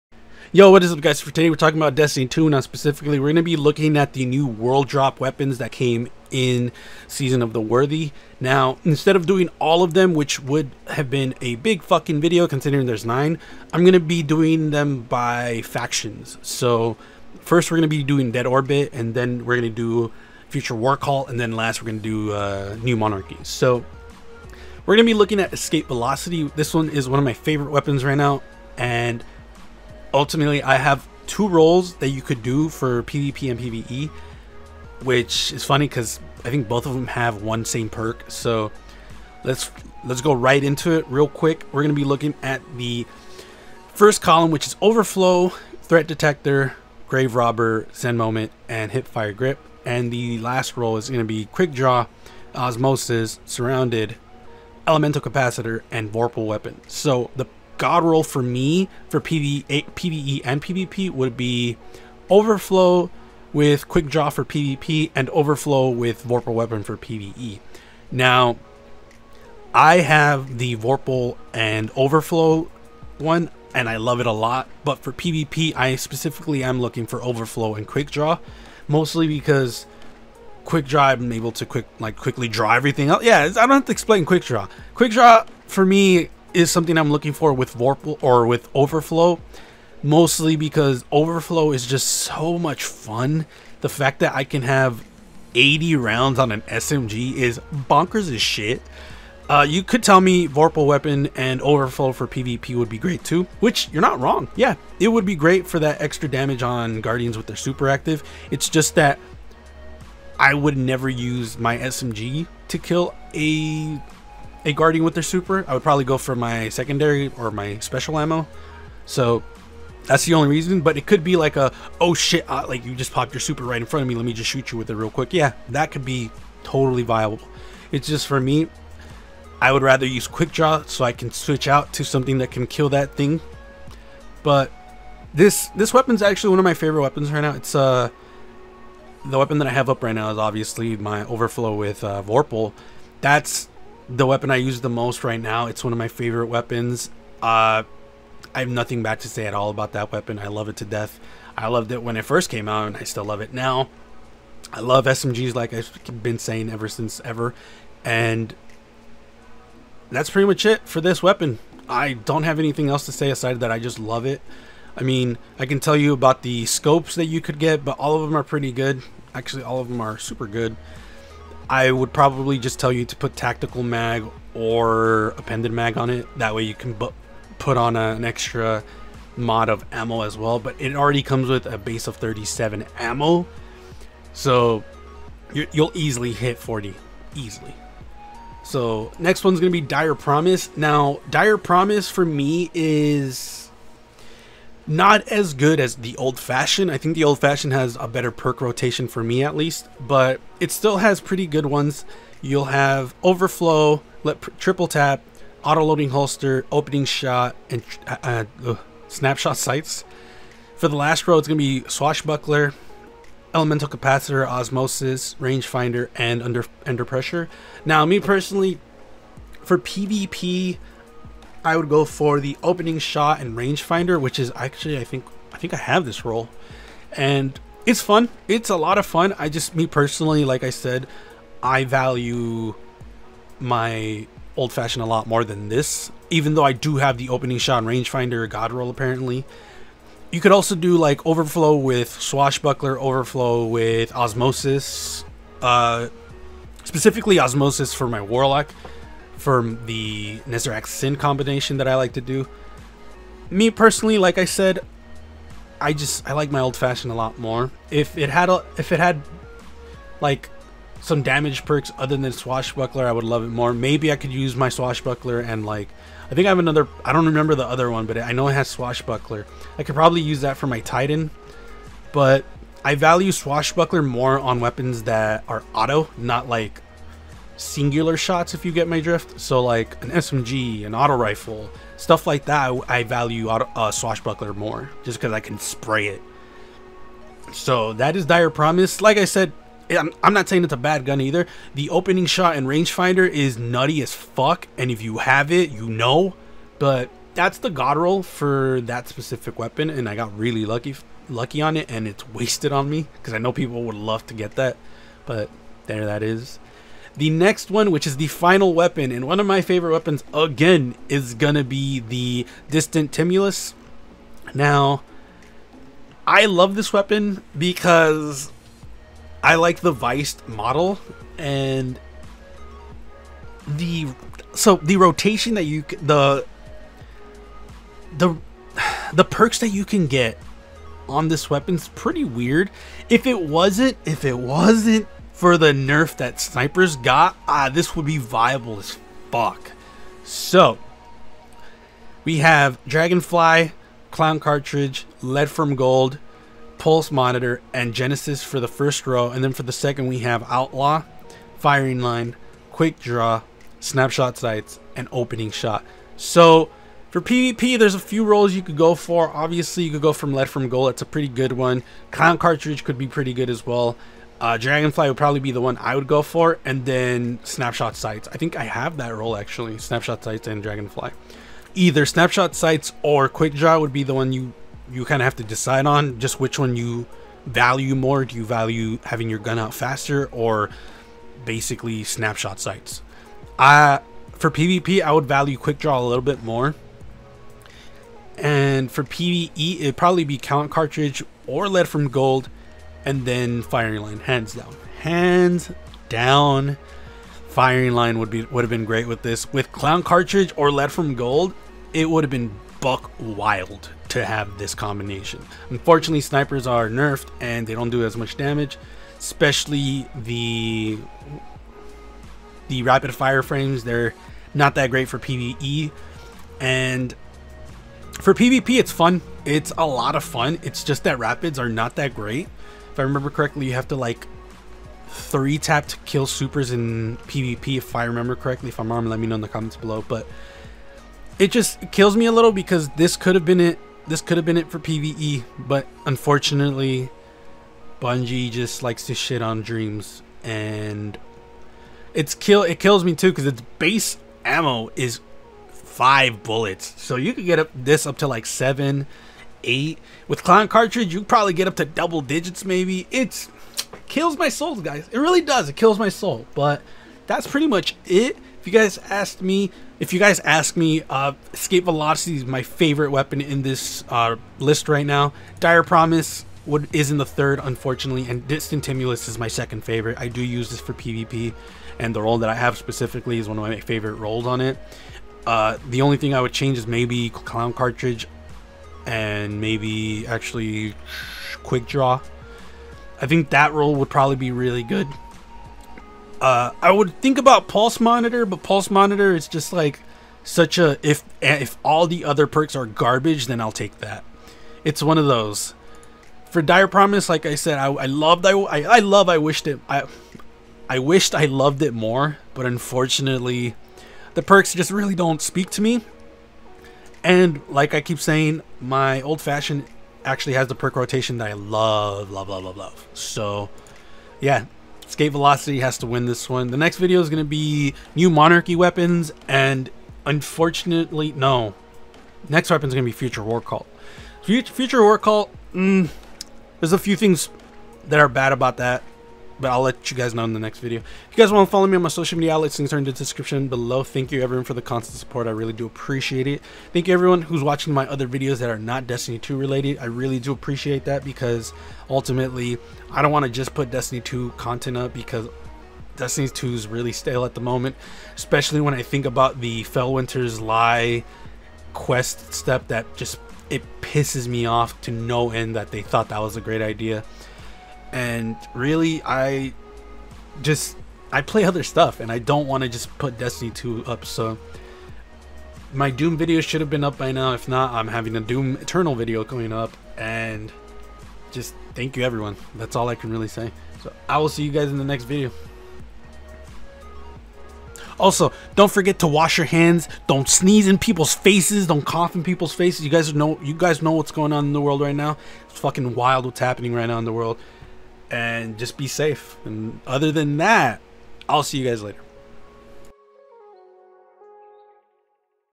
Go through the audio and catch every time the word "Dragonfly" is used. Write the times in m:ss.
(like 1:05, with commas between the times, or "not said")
5:42, 6:04, 6:10.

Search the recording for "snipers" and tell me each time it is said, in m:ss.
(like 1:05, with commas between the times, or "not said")
5:36, 6:46.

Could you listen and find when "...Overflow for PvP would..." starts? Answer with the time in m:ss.
1:41.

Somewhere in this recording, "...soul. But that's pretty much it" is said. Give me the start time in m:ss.
7:36.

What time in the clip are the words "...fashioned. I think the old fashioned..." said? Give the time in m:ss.
3:16.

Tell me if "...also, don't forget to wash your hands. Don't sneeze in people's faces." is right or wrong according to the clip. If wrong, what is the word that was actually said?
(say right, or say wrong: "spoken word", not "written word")
right.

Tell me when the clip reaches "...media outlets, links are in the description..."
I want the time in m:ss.
8:52.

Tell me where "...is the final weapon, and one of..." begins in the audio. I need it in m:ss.
5:08.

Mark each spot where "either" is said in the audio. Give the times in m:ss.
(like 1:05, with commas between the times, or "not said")
4:51, 6:11.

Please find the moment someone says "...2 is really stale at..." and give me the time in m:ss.
9:06.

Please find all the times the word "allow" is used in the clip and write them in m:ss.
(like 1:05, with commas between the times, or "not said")
not said.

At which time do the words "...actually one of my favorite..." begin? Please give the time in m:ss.
2:16.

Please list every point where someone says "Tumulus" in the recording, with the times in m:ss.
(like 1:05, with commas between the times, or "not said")
5:13, 7:48.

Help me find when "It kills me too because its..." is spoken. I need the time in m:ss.
7:22.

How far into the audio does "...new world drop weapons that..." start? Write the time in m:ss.
0:04.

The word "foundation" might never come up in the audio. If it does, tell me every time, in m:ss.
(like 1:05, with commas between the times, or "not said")
not said.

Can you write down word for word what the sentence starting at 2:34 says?
I love SMGs like I've been saying ever since ever.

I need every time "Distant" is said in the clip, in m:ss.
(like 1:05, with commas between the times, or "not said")
5:12, 7:48.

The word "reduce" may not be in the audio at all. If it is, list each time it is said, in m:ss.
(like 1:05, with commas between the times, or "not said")
not said.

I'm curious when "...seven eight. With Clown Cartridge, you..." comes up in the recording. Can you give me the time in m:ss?
7:28.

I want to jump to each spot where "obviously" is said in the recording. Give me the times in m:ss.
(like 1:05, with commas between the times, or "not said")
2:20, 5:59.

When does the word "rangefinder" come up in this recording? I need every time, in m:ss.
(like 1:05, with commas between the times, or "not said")
3:35, 3:43, 3:57, 4:52.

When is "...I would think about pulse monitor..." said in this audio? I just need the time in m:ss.
8:06.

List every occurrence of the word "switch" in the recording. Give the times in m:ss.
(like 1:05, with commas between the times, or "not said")
2:11.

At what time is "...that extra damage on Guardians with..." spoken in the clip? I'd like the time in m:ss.
1:45.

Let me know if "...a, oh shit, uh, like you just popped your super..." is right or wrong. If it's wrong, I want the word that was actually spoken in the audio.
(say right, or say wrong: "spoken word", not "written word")
right.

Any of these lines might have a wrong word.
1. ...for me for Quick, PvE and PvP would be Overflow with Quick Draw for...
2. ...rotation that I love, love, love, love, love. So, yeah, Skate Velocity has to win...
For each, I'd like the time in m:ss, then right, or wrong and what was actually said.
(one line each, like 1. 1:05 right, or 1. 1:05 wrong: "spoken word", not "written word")
1. 0:58 wrong: "PvE", not "Quick"
2. 8:30 right.